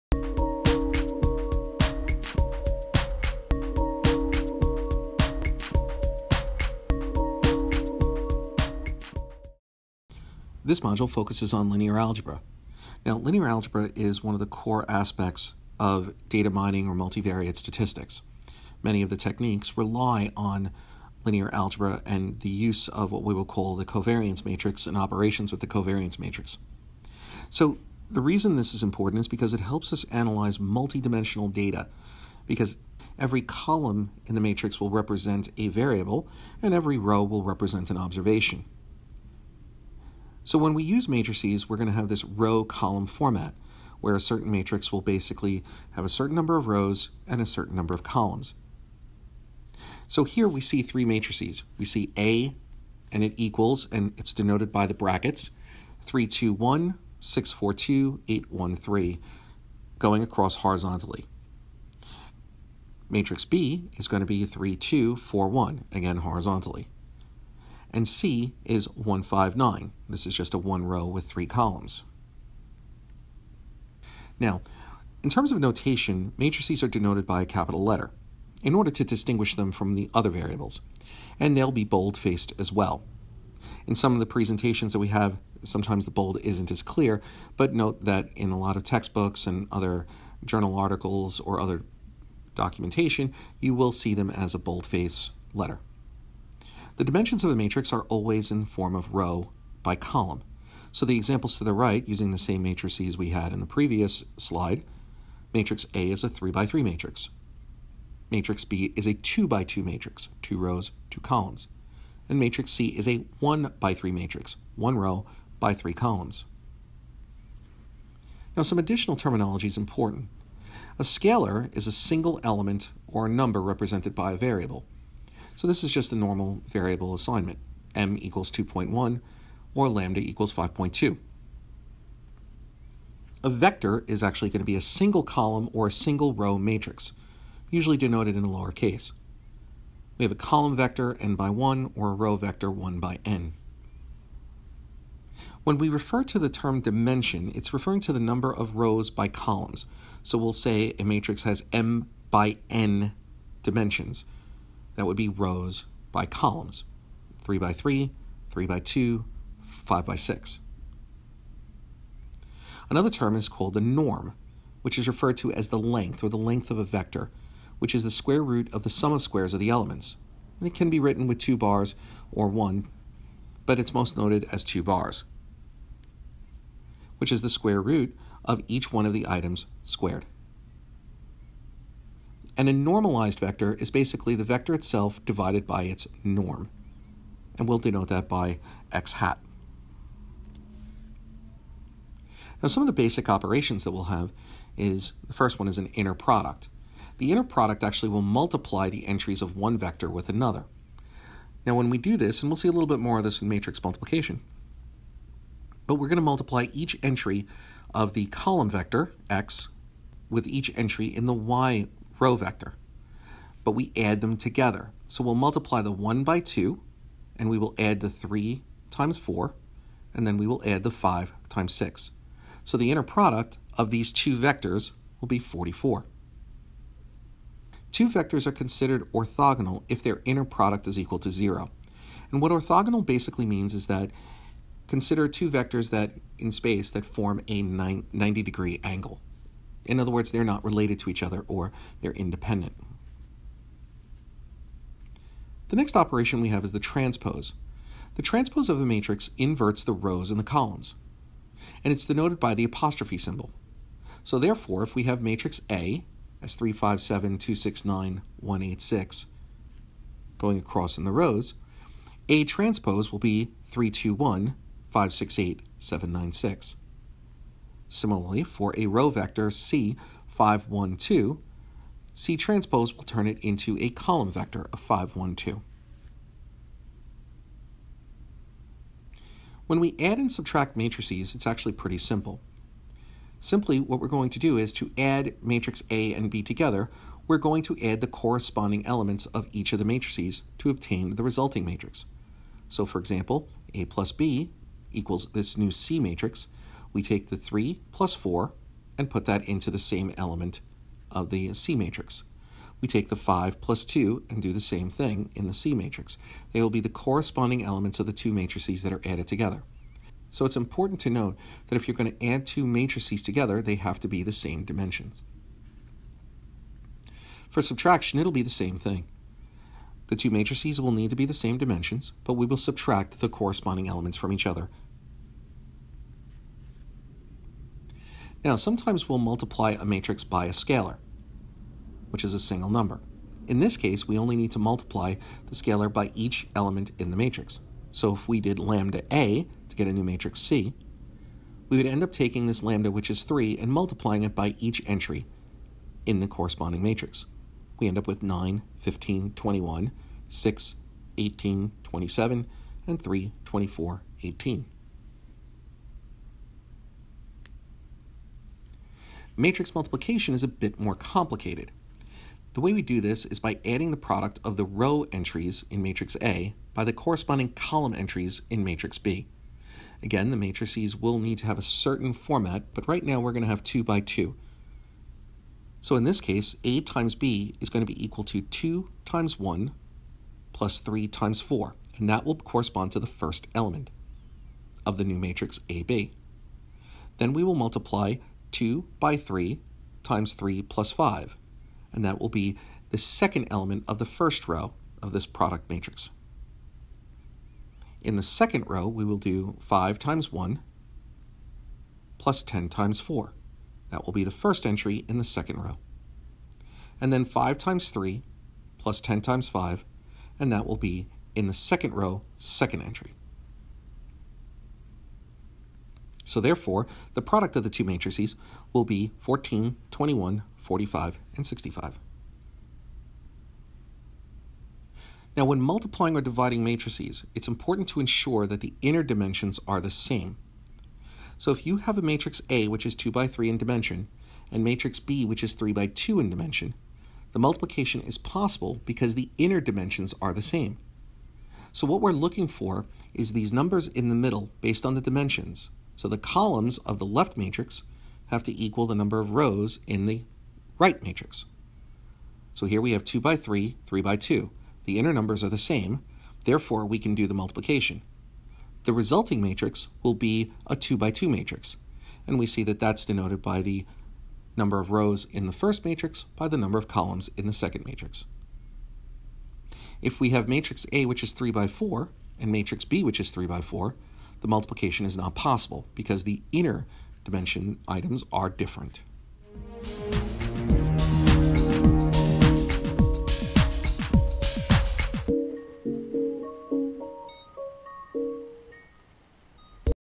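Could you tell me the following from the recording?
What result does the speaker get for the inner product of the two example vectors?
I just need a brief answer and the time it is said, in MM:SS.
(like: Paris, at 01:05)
44, at 03:45.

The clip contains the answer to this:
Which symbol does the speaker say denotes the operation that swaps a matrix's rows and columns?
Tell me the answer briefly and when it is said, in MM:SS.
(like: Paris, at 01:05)
apostrophe, at 04:12.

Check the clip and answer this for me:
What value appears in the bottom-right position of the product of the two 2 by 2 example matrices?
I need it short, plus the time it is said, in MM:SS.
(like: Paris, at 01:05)
65, at 07:01.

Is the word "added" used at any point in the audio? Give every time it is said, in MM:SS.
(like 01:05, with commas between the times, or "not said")
05:09.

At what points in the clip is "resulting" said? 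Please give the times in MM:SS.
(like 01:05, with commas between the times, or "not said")
04:51, 07:38.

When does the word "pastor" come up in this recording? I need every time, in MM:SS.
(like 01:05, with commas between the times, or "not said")
not said.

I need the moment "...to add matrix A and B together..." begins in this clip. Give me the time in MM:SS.
04:44.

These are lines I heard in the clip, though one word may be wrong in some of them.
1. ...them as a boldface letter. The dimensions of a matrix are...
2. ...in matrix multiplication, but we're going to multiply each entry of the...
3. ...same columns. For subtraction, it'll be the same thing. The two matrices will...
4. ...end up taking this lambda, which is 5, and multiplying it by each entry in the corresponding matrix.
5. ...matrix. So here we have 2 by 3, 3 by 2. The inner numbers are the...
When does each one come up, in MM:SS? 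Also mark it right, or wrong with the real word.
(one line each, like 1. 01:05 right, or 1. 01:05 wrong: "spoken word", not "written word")
1. 01:34 right
2. 03:23 right
3. 05:14 wrong: "dimensions", not "columns"
4. 05:41 wrong: "3", not "5"
5. 07:31 right.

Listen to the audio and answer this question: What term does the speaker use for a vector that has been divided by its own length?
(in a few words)
normalized vector.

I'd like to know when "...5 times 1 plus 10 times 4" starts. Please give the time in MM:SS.
06:39.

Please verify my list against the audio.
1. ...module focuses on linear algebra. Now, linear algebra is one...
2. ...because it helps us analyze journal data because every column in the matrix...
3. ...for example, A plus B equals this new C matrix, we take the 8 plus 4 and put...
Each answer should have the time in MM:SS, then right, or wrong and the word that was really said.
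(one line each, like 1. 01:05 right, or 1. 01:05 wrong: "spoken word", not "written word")
1. 00:10 right
2. 00:29 wrong: "multidimensional", not "journal"
3. 04:52 wrong: "3", not "8".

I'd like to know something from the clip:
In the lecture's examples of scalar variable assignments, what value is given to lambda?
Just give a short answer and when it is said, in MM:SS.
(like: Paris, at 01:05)
5.2, at 02:09.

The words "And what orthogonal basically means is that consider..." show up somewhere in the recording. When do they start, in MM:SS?
03:52.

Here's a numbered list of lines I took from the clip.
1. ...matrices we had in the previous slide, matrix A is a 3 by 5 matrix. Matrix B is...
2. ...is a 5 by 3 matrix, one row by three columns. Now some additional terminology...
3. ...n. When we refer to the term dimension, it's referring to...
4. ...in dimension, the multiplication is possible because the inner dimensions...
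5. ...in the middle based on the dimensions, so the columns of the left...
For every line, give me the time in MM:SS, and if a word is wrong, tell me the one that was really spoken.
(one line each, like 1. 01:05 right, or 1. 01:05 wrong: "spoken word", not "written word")
1. 01:42 wrong: "3", not "5"
2. 01:52 wrong: "1", not "5"
3. 02:23 right
4. 07:16 right
5. 07:23 right.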